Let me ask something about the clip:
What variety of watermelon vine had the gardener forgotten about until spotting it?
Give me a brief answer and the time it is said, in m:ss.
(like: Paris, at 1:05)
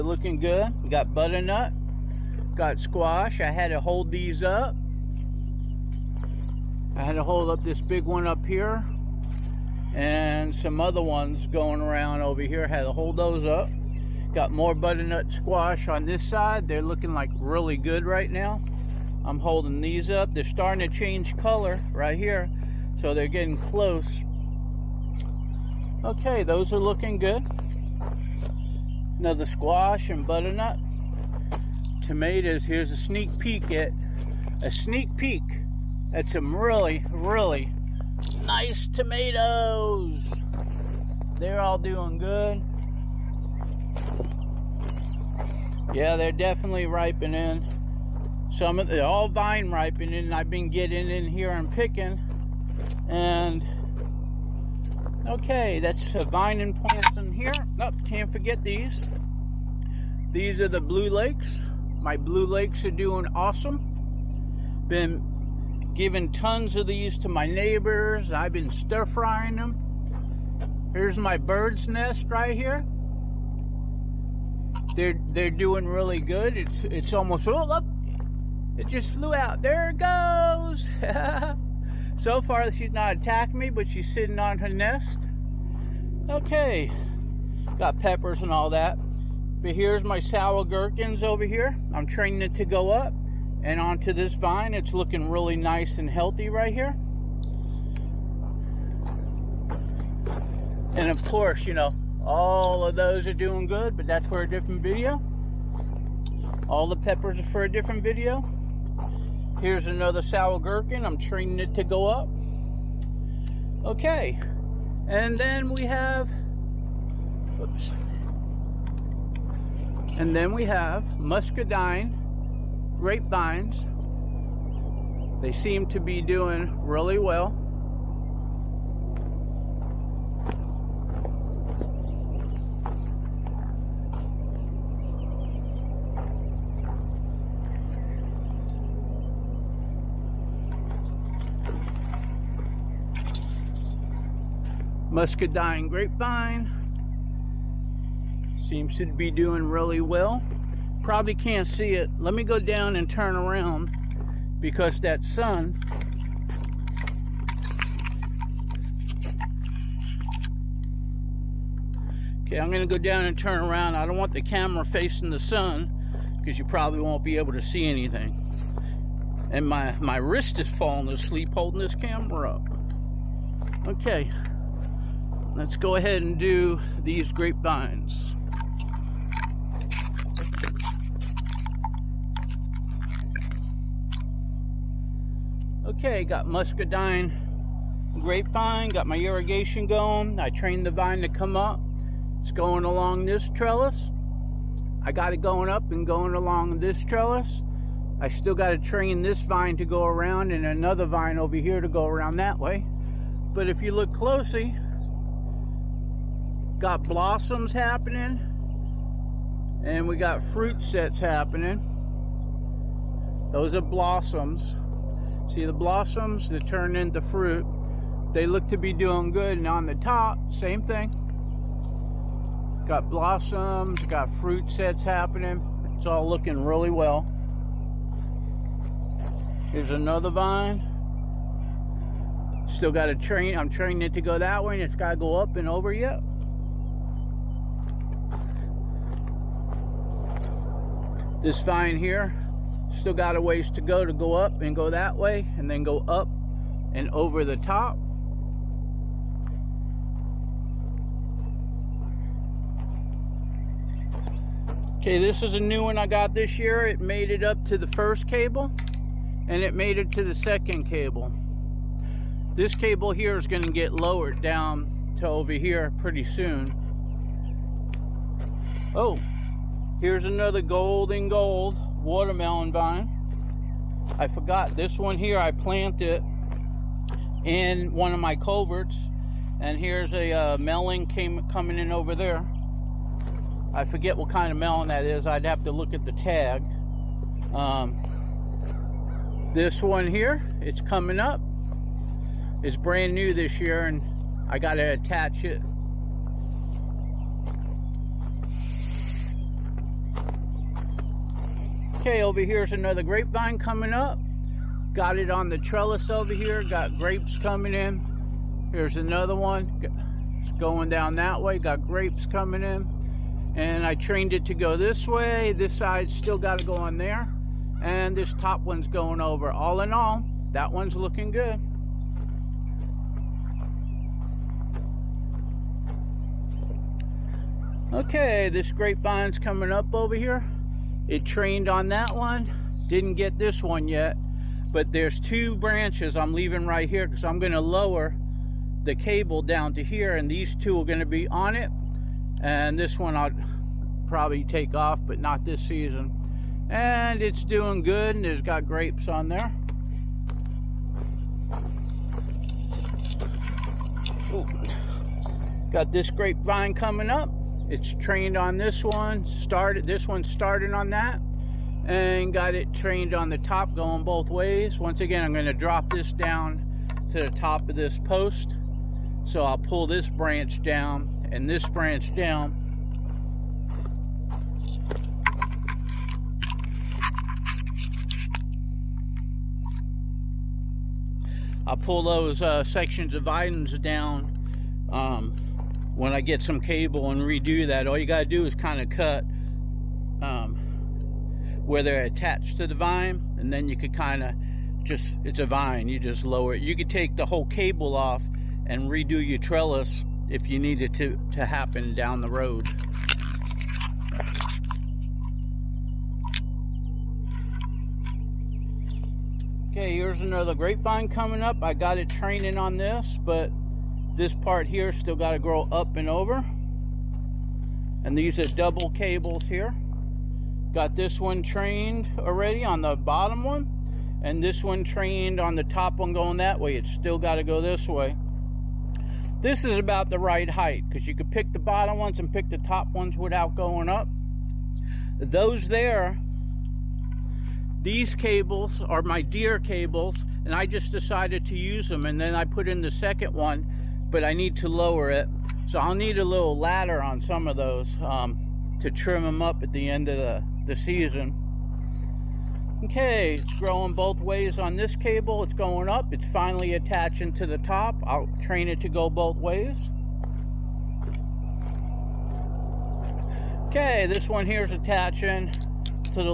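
golden gold, at 4:30.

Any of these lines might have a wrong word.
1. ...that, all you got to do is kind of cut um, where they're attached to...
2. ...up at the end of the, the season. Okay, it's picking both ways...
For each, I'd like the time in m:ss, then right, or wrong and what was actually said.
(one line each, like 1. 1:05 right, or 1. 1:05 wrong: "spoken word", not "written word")
1. 6:27 right
2. 7:29 wrong: "growing", not "picking".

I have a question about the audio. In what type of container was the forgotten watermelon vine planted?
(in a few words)
culverts.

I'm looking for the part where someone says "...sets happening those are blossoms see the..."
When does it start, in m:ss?
3:30.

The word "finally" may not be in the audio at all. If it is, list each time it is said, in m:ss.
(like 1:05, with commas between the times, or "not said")
7:36.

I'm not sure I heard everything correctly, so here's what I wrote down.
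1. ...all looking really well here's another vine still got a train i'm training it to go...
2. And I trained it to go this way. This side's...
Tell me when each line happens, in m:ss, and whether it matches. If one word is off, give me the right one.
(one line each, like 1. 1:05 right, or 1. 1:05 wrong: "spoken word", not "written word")
1. 3:46 right
2. 5:13 right.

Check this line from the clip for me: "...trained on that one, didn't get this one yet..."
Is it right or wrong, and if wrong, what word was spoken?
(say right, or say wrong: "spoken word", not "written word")
right.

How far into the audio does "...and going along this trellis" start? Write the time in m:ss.
3:15.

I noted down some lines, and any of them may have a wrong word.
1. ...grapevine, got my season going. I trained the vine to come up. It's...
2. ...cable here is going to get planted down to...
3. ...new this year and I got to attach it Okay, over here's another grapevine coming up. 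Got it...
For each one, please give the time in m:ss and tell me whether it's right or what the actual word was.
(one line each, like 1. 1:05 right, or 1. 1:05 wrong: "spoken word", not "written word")
1. 3:08 wrong: "irrigation", not "season"
2. 4:22 wrong: "lowered", not "planted"
3. 4:53 right.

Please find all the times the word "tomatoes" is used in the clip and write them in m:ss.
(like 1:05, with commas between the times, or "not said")
0:32, 0:38.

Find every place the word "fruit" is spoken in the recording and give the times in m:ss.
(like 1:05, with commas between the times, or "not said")
3:30, 3:37, 3:44.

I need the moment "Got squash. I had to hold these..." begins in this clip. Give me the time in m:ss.
0:02.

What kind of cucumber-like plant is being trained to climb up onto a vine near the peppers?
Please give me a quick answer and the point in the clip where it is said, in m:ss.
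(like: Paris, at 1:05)
sour gherkins, at 1:30.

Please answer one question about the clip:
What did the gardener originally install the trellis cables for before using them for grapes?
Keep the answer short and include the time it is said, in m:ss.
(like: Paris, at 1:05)
deer, at 7:19.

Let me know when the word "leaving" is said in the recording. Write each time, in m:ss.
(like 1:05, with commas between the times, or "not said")
5:36.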